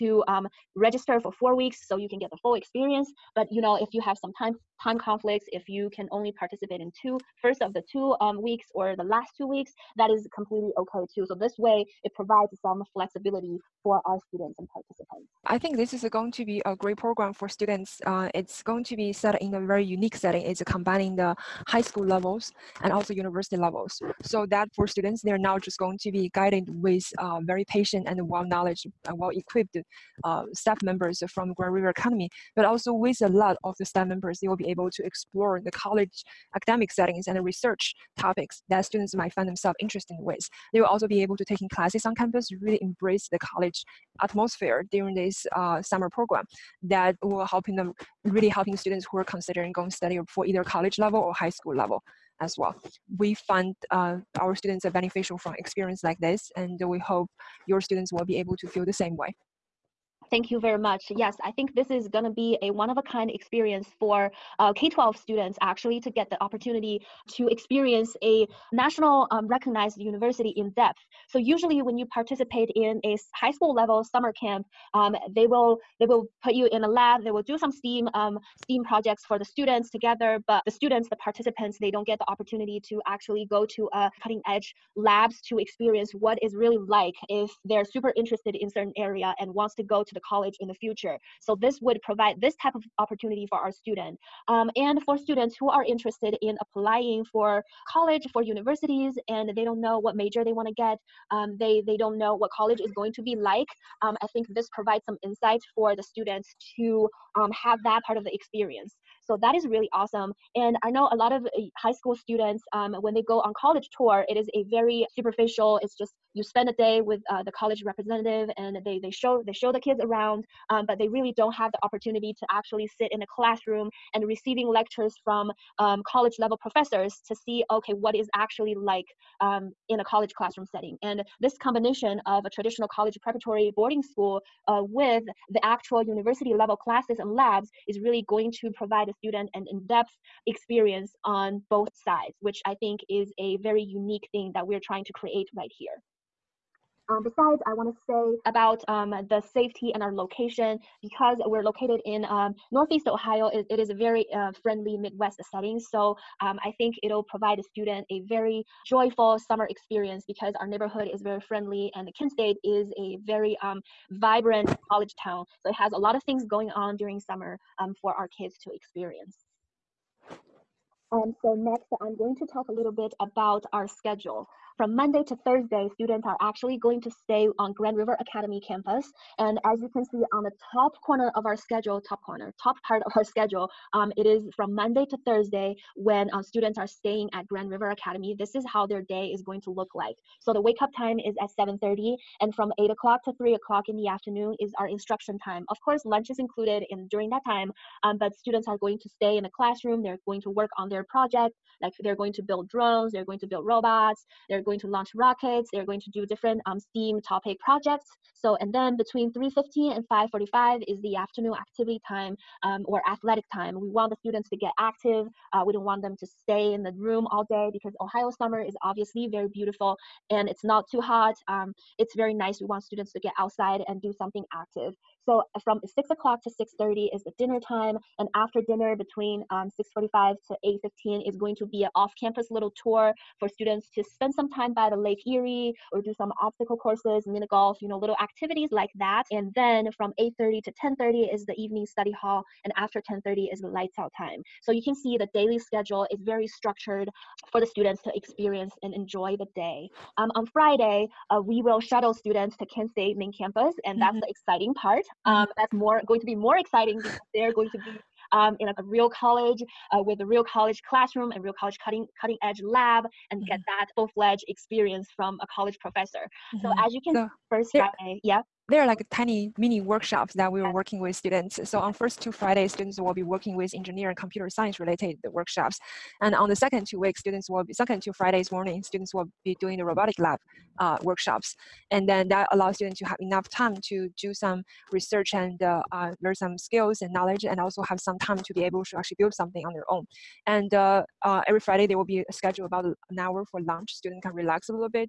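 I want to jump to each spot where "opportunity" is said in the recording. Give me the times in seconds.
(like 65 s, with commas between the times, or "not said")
66 s, 82 s, 92 s, 121 s.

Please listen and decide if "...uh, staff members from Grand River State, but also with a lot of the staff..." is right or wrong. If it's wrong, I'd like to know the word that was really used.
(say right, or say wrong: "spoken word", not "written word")
wrong: "Academy", not "State".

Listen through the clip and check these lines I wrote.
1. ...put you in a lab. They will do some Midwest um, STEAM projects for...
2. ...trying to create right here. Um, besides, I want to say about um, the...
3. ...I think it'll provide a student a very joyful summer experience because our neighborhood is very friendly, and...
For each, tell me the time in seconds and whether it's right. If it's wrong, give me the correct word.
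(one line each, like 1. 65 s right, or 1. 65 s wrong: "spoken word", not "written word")
1. 76 s wrong: "STEAM", not "Midwest"
2. 144 s right
3. 156 s right.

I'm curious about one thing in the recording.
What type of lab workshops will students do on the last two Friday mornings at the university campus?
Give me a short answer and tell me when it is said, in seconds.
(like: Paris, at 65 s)
robotic lab, at 279 s.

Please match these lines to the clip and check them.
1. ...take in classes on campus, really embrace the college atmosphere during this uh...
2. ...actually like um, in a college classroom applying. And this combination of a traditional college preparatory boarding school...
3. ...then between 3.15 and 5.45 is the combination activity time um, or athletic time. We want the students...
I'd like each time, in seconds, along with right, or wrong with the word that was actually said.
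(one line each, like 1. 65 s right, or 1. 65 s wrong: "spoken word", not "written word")
1. 41 s right
2. 128 s wrong: "setting", not "applying"
3. 208 s wrong: "afternoon", not "combination".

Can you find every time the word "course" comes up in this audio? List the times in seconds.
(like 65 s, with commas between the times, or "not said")
195 s, 236 s.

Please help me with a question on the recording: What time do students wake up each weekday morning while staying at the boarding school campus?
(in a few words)
7:30.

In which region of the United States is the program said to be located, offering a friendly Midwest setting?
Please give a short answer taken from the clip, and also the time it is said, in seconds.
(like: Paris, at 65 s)
Northeast Ohio, at 152 s.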